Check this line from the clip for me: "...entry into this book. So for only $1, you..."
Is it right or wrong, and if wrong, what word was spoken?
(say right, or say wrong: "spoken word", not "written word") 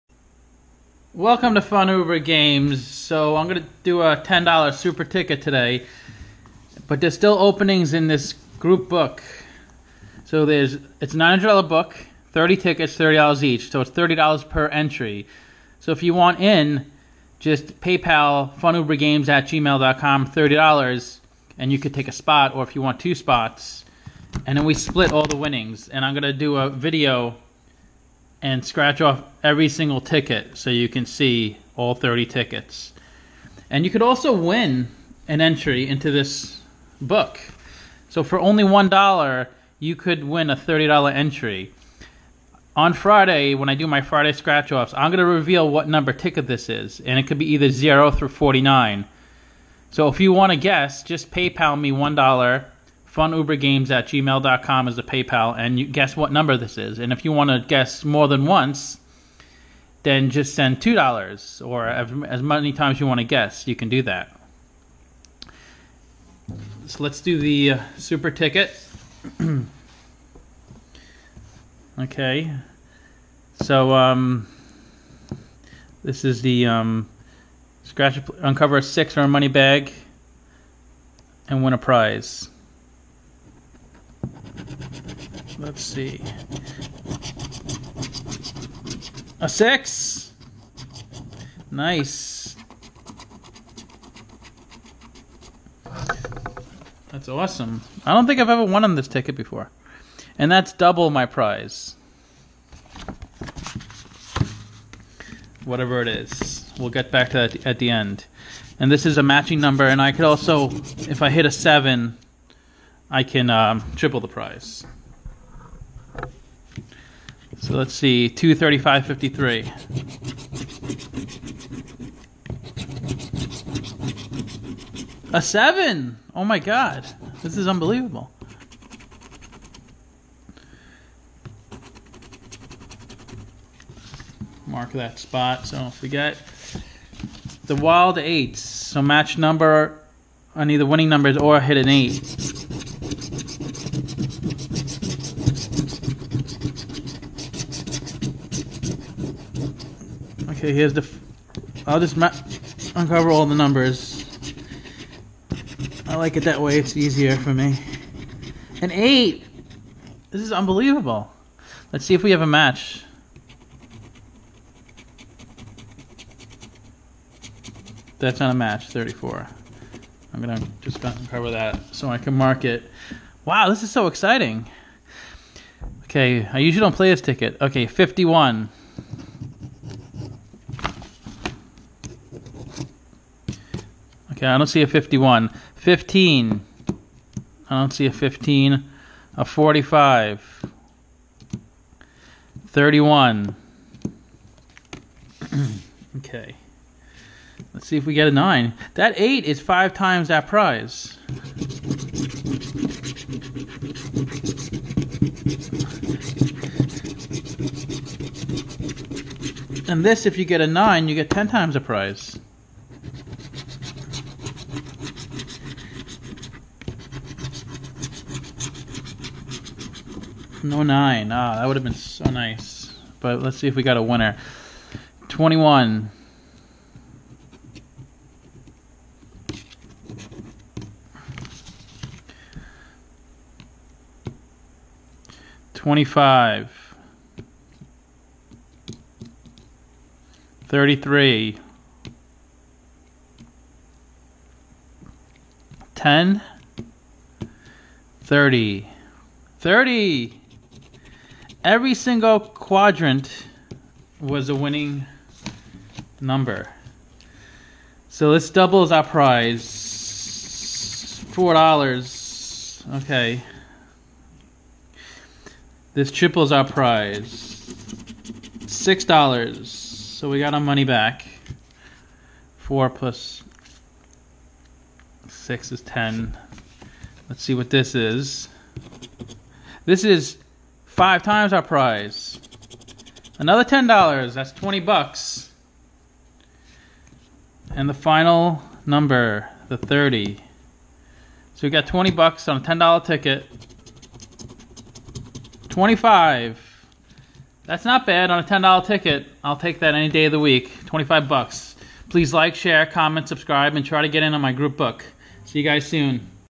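right.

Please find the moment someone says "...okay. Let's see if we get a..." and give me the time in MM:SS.
03:16.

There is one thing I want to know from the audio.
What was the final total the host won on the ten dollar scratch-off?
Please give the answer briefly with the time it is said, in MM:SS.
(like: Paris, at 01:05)
$25, at 05:00.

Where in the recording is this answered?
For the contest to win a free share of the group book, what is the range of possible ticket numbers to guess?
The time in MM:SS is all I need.
00:47.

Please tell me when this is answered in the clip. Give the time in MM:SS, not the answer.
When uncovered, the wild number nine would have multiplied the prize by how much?
03:31.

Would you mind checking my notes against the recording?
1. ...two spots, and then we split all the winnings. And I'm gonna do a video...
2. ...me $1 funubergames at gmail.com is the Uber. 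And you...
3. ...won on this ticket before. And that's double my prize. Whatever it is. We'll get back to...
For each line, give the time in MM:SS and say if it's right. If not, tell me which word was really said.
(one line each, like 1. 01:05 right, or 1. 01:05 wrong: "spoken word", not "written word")
1. 00:23 right
2. 00:51 wrong: "PayPal", not "Uber"
3. 01:38 right.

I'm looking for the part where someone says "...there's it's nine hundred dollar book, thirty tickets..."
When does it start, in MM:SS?
00:10.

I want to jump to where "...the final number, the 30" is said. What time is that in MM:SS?
04:47.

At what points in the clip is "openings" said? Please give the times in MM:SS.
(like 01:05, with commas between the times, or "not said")
00:07.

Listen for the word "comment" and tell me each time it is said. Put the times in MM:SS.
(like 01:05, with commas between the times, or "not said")
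05:02.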